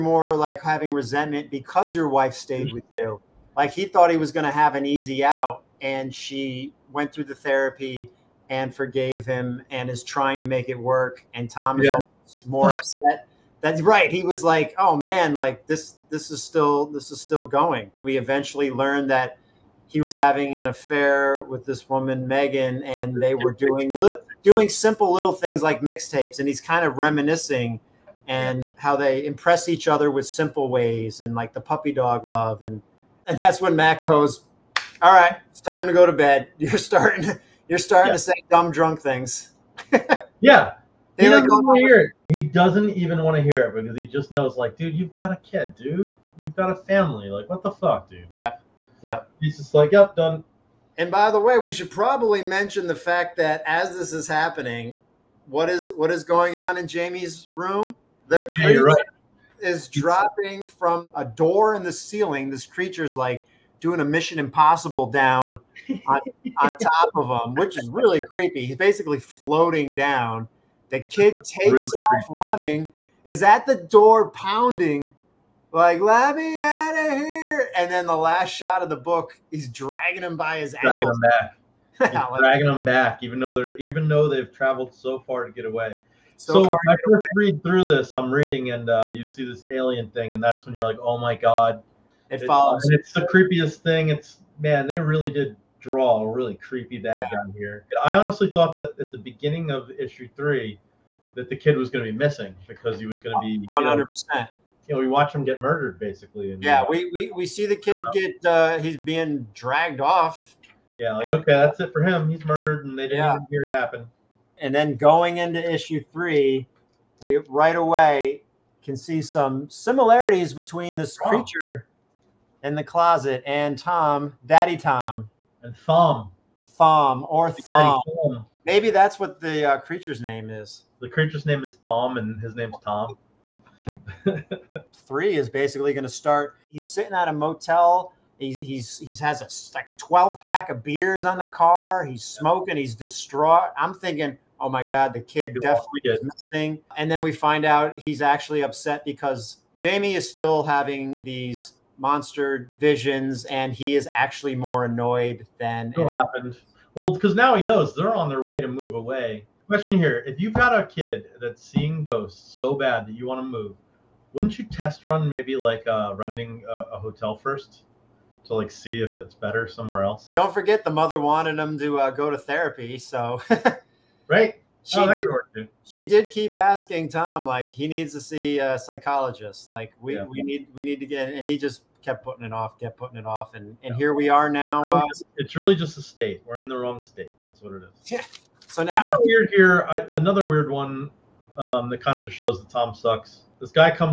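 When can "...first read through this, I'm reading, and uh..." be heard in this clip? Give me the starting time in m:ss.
1:27.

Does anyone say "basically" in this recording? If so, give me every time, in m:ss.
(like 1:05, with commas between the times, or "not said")
1:08, 1:45, 2:15.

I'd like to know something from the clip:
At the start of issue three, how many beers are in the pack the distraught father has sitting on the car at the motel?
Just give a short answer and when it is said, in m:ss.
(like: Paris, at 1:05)
12, at 2:19.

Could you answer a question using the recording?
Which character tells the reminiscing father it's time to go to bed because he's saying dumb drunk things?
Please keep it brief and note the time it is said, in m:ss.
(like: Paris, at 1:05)
Matt, at 0:33.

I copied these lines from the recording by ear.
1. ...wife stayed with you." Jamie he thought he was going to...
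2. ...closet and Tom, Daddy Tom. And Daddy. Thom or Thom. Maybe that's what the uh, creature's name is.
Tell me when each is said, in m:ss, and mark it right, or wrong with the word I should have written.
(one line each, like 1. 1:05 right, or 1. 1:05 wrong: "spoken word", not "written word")
1. 0:02 wrong: "Like", not "Jamie"
2. 2:02 wrong: "Thom", not "Daddy".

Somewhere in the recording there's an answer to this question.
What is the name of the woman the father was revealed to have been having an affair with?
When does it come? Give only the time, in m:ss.
0:22.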